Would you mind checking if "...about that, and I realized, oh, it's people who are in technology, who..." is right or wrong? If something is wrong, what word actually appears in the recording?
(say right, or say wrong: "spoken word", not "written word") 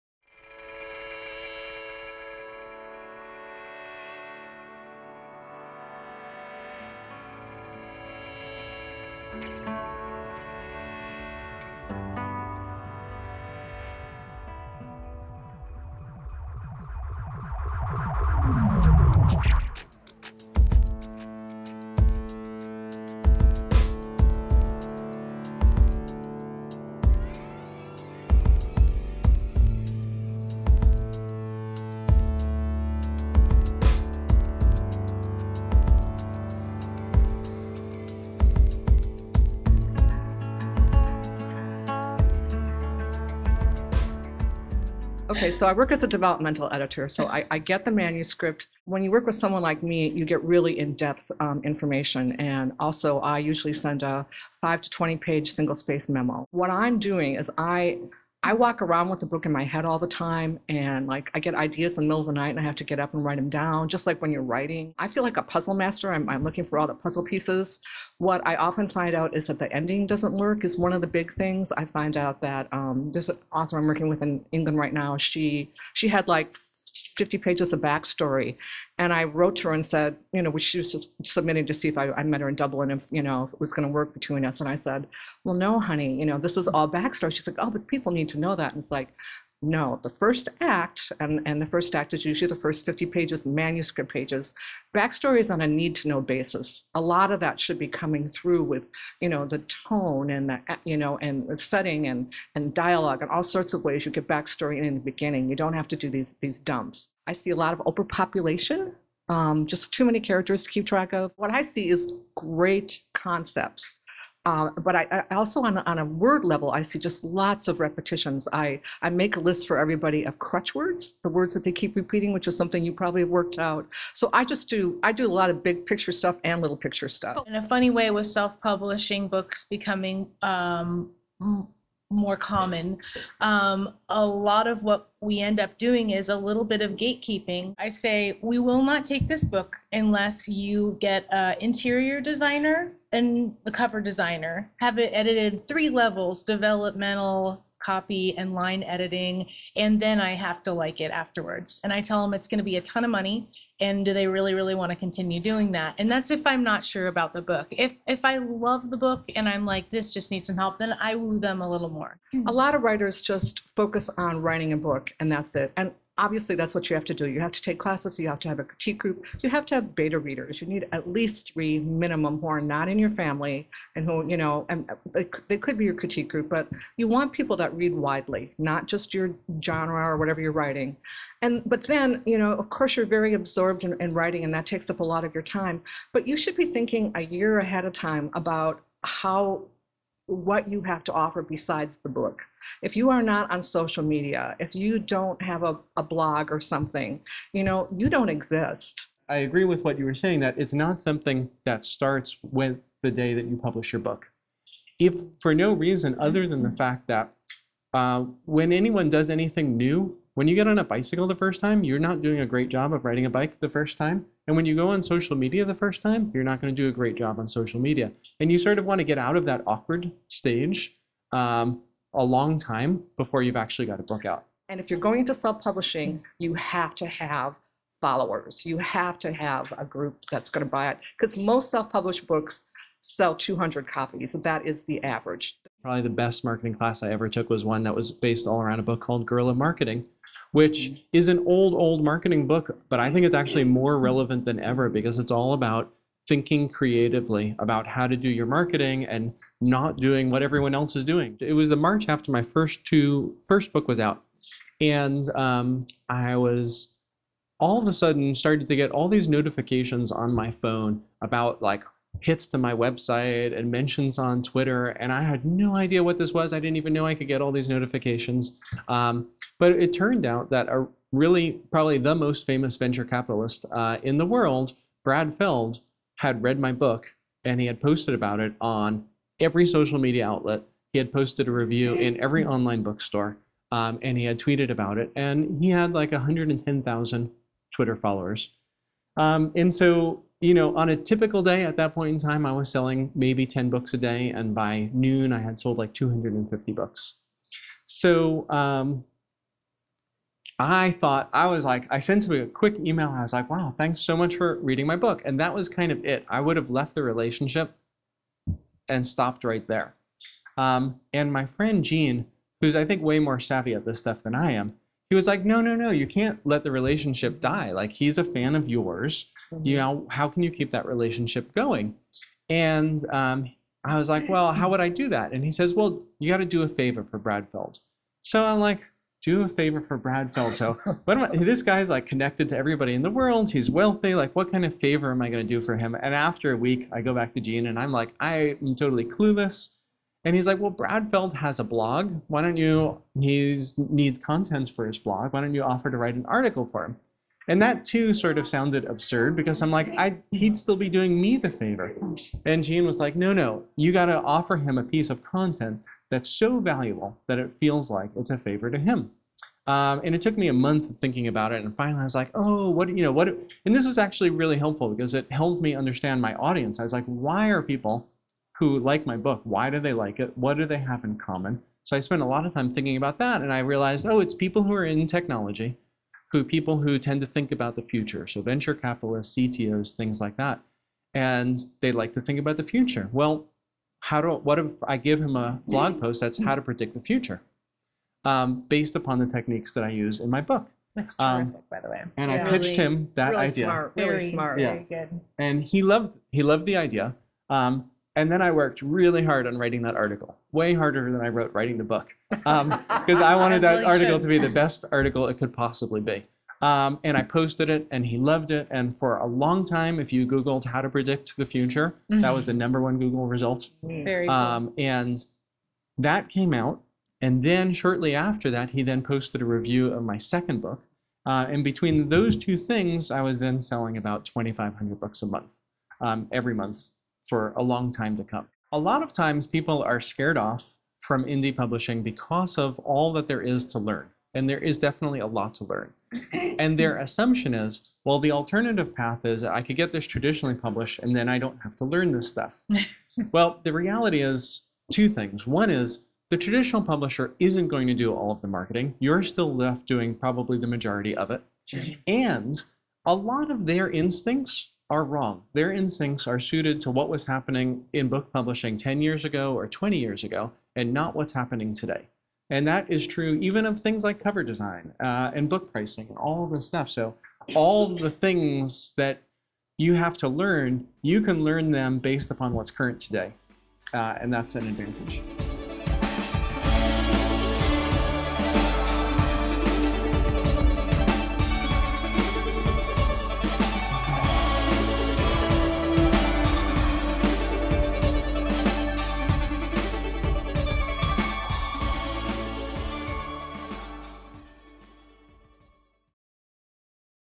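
right.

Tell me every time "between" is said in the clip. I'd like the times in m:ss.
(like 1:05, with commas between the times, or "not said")
1:24, 7:01.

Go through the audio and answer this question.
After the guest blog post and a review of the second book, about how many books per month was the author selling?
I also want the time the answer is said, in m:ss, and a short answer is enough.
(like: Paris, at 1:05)
2,500, at 7:04.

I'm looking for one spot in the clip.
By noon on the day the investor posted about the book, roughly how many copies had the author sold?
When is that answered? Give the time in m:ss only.
4:55.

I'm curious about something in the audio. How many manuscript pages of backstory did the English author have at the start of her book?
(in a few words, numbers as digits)
50.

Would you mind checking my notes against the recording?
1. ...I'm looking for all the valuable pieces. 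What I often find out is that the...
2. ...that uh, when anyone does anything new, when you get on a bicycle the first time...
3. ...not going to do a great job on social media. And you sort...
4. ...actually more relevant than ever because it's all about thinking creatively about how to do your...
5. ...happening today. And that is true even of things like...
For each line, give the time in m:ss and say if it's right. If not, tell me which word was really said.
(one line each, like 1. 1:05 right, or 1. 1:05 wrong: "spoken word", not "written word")
1. 1:06 wrong: "puzzle", not "valuable"
2. 3:27 right
3. 3:36 right
4. 4:03 right
5. 7:41 right.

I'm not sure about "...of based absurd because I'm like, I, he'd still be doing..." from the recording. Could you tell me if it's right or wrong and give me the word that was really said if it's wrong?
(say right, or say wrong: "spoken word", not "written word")
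wrong: "sounded", not "based".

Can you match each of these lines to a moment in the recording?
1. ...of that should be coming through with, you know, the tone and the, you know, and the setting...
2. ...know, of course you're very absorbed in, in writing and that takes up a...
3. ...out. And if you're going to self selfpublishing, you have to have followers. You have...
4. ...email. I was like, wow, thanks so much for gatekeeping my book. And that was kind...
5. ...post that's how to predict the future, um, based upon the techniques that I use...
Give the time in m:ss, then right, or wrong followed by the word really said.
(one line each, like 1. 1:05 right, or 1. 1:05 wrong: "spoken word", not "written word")
1. 1:37 right
2. 3:02 right
3. 3:44 wrong: "publishing", not "selfpublishing"
4. 5:02 wrong: "reading", not "gatekeeping"
5. 6:25 right.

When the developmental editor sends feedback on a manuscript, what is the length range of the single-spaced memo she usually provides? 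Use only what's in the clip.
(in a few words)
5 to 20 pages.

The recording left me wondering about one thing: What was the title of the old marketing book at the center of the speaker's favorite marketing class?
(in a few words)
Guerrilla Marketing.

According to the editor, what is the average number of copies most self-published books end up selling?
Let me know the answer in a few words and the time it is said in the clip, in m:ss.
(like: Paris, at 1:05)
200, at 3:53.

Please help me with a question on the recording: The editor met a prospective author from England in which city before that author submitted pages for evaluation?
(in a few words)
Dublin.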